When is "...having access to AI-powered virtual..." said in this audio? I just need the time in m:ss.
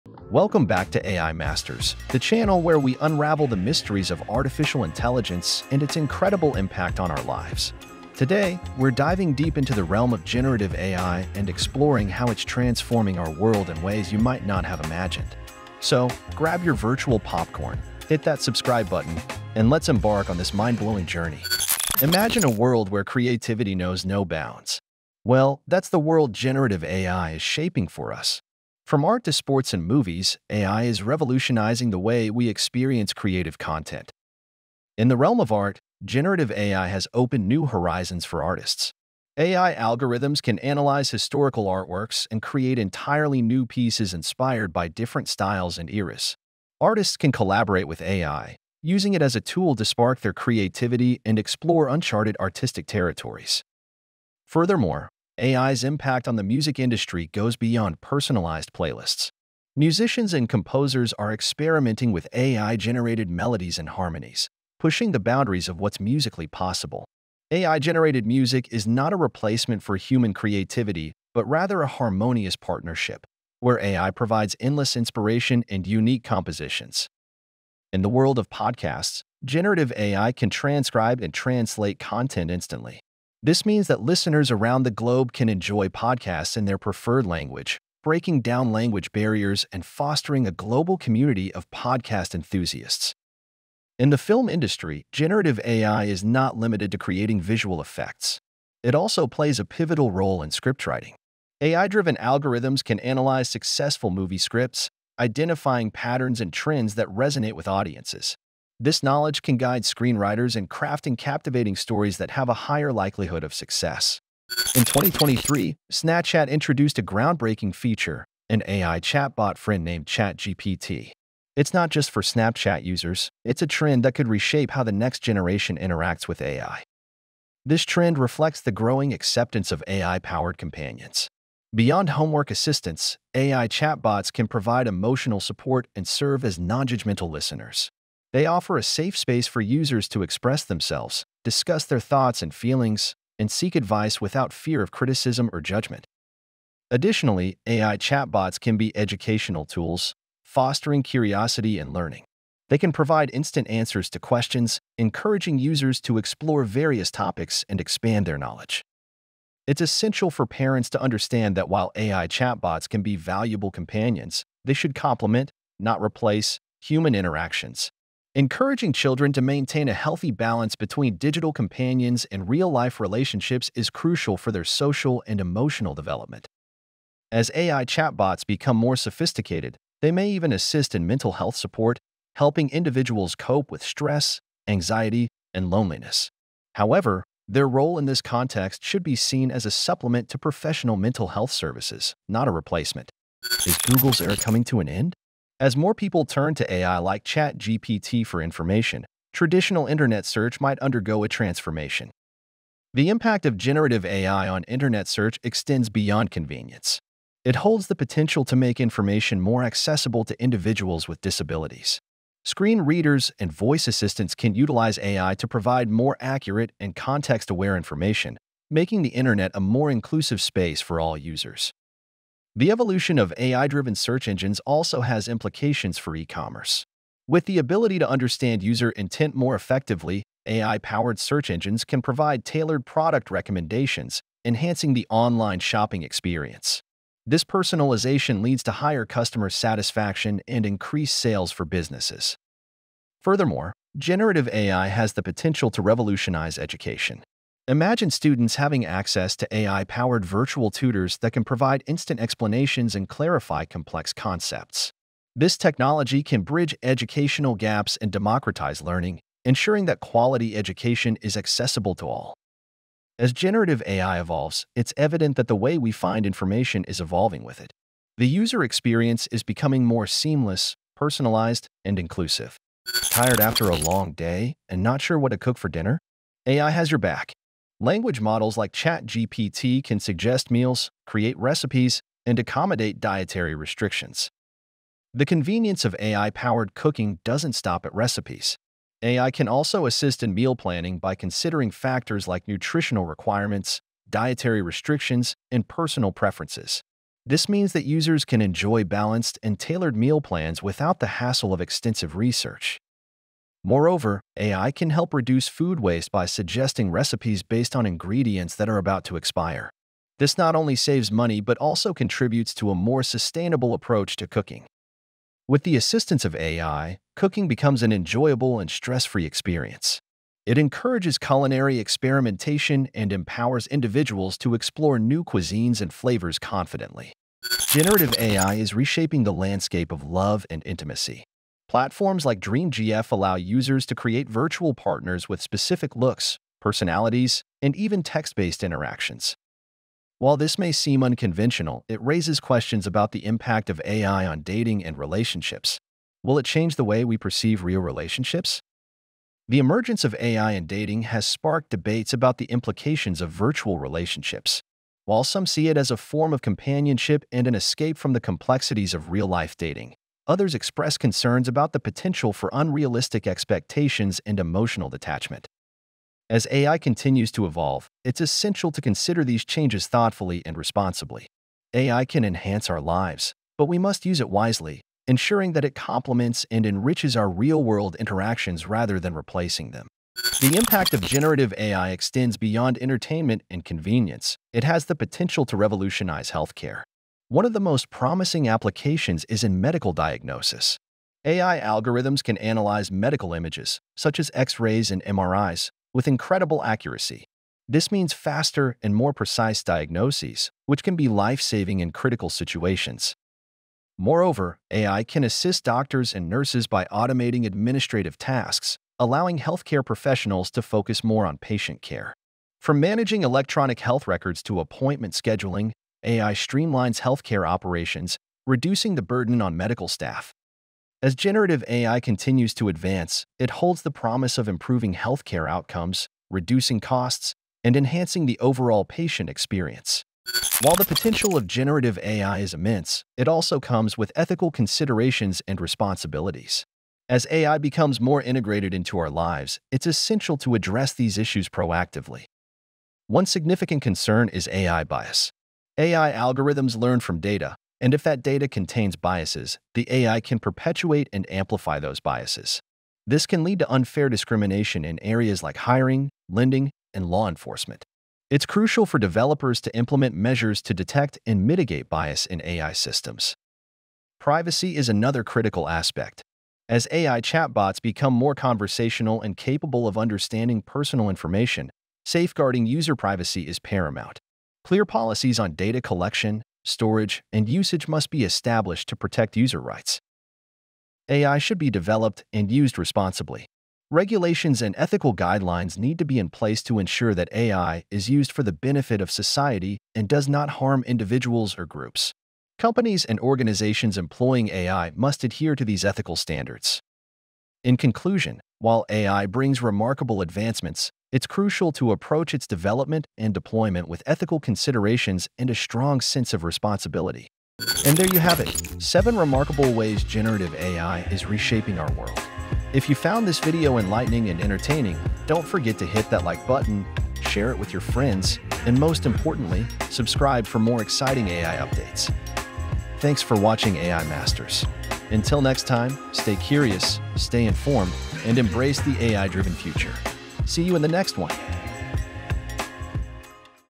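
4:08.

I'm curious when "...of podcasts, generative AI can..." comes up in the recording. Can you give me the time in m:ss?
1:18.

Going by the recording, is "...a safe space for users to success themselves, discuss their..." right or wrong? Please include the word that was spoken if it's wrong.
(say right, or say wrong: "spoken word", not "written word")
wrong: "express", not "success".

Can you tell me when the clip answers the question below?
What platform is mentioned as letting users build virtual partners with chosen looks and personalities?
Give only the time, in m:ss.
5:32.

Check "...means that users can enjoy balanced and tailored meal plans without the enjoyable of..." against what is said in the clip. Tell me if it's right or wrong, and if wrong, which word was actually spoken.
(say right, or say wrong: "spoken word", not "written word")
wrong: "hassle", not "enjoyable".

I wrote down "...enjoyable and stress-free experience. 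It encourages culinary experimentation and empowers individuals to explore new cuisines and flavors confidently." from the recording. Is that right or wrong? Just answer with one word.
right.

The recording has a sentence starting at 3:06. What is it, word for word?
However, their role in this context should be seen as a supplement to professional mental health services, not a replacement.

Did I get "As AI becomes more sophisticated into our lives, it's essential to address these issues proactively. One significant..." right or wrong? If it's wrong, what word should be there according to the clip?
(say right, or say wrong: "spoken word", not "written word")
wrong: "integrated", not "sophisticated".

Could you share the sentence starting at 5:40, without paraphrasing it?
While this may seem unconventional, it raises questions about the impact of AI on dating and relationships.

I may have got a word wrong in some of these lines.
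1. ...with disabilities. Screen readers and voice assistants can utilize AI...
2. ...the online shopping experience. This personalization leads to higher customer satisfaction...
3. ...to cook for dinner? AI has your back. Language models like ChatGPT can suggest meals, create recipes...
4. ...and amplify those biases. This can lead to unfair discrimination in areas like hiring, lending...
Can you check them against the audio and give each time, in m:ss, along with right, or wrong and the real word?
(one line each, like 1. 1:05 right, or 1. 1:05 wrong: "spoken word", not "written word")
1. 3:31 right
2. 3:54 right
3. 4:35 right
4. 7:31 right.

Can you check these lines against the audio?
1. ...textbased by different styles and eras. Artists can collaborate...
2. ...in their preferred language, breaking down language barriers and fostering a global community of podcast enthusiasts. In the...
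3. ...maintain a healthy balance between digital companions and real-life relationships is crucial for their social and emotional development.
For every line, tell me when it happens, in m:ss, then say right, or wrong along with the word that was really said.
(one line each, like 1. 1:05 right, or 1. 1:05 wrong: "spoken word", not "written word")
1. 0:44 wrong: "inspired", not "textbased"
2. 1:26 right
3. 2:49 right.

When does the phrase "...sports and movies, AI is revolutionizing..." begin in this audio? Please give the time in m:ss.
0:29.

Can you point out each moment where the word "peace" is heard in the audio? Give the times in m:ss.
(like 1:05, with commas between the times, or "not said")
not said.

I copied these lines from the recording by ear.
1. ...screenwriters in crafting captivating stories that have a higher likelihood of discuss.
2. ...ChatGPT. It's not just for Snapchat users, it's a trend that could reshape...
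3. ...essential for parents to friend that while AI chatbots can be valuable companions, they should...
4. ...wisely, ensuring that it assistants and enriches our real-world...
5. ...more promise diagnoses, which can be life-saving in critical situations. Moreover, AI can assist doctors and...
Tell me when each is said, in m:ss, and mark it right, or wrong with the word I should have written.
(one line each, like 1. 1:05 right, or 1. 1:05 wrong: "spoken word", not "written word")
1. 1:49 wrong: "success", not "discuss"
2. 2:00 right
3. 2:39 wrong: "understand", not "friend"
4. 6:14 wrong: "complements", not "assistants"
5. 6:38 wrong: "precise", not "promise".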